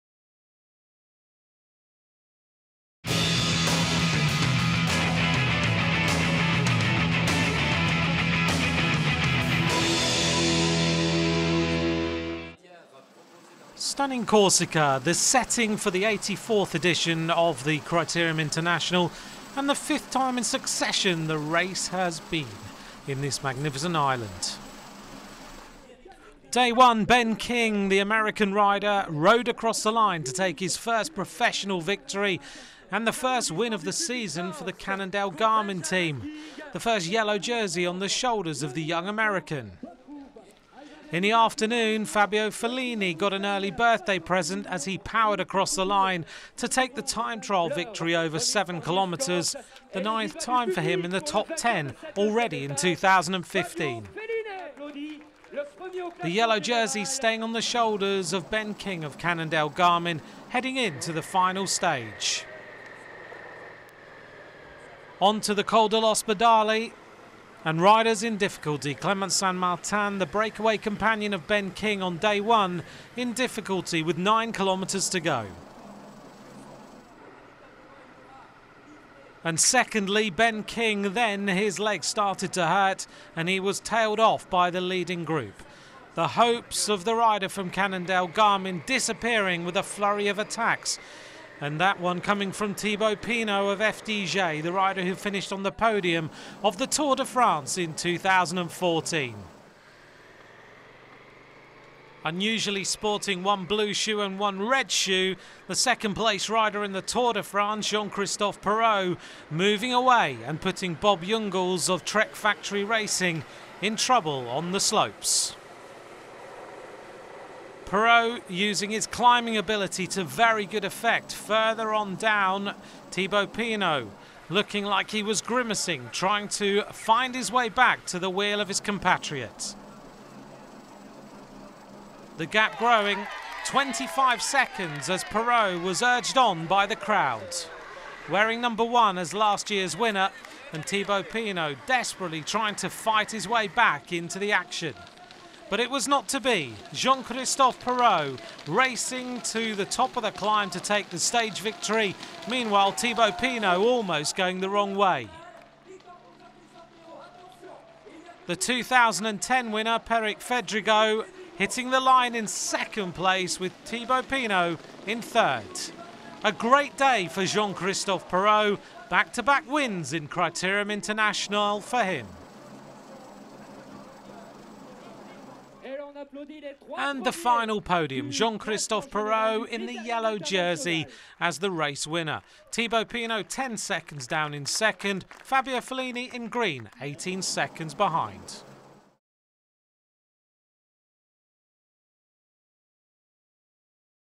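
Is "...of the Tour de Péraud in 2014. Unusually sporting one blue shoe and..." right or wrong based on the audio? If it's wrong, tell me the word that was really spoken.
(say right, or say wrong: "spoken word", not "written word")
wrong: "France", not "Péraud".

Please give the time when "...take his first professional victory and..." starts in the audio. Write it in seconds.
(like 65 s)
30 s.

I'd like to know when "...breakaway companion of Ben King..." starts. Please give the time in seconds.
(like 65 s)
70 s.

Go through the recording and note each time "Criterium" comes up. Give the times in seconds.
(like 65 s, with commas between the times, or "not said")
17 s, 170 s.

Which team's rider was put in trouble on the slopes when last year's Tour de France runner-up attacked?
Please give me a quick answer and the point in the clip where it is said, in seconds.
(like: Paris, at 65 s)
Trek Factory Racing, at 112 s.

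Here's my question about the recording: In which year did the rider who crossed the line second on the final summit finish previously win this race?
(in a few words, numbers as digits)
2010.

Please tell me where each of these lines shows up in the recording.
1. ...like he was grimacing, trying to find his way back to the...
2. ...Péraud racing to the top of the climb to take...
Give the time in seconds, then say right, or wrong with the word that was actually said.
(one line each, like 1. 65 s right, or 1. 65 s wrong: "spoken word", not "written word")
1. 124 s right
2. 147 s right.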